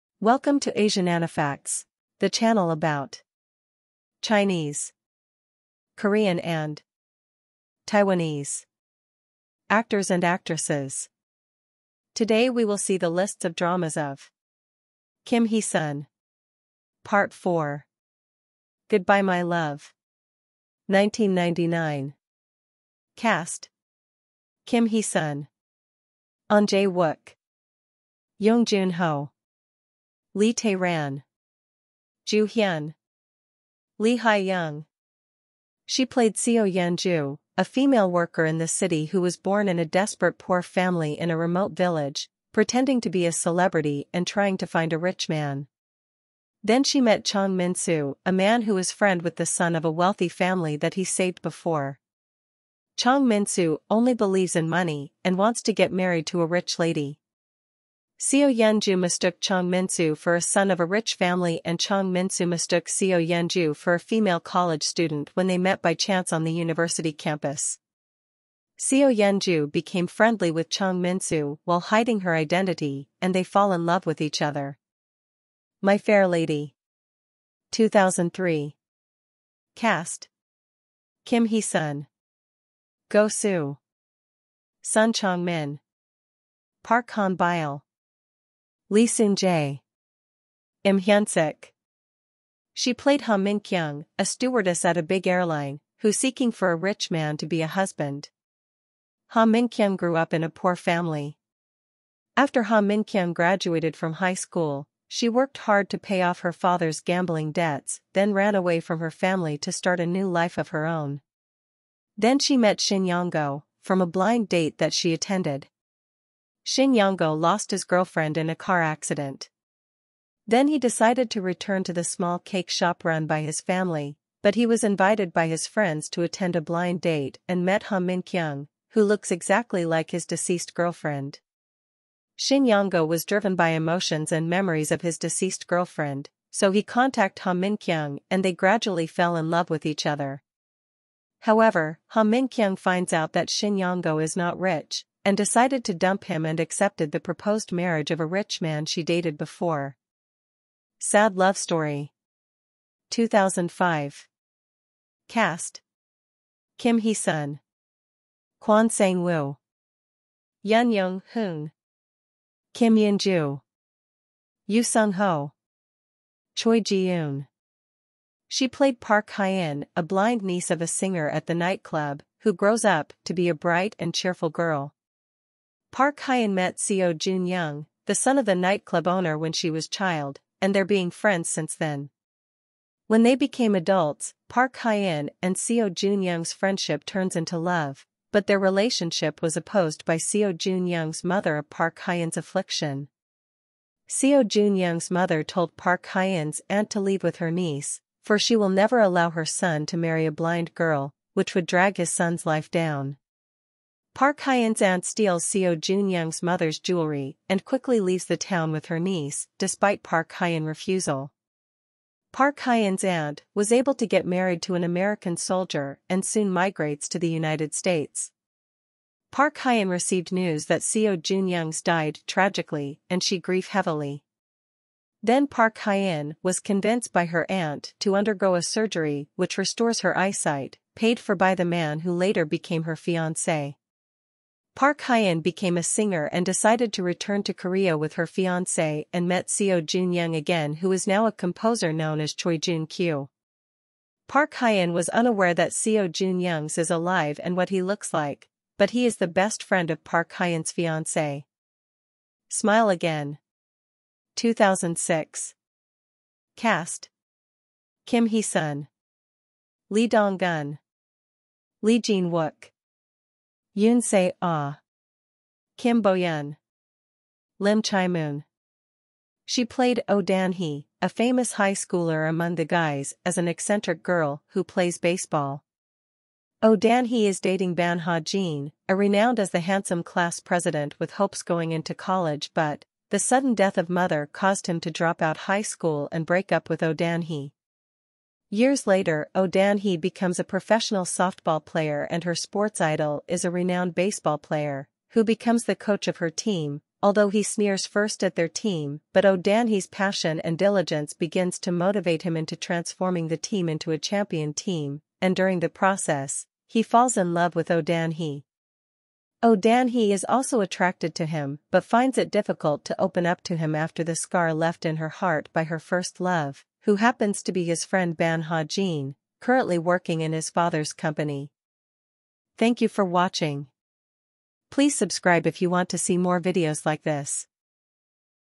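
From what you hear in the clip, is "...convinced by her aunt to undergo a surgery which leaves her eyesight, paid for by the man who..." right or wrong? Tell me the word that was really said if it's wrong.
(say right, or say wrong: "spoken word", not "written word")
wrong: "restores", not "leaves".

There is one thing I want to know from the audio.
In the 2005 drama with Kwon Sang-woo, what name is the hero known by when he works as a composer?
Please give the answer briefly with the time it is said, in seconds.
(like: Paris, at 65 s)
Choi Jun Kyu, at 242 s.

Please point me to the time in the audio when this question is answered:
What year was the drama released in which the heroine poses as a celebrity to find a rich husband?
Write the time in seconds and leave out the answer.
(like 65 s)
20 s.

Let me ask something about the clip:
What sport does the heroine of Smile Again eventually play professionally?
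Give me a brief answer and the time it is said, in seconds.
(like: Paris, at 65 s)
Softball, at 291 s.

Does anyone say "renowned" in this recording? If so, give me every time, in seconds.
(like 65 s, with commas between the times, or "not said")
278 s, 293 s.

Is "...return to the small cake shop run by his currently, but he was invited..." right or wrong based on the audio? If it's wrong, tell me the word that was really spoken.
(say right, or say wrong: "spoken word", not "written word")
wrong: "family", not "currently".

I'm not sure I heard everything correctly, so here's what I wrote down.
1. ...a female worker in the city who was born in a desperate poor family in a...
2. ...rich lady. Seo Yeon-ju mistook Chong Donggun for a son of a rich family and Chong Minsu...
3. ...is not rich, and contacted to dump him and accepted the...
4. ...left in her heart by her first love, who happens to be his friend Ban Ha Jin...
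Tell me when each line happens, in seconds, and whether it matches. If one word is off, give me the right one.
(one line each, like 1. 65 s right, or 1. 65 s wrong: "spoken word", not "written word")
1. 37 s right
2. 56 s wrong: "Minsu", not "Donggun"
3. 144 s wrong: "decided", not "contacted"
4. 314 s right.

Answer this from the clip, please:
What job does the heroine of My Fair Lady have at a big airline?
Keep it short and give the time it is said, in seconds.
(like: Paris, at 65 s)
Stewardess, at 94 s.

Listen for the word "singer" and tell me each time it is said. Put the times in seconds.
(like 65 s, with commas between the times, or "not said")
170 s, 235 s.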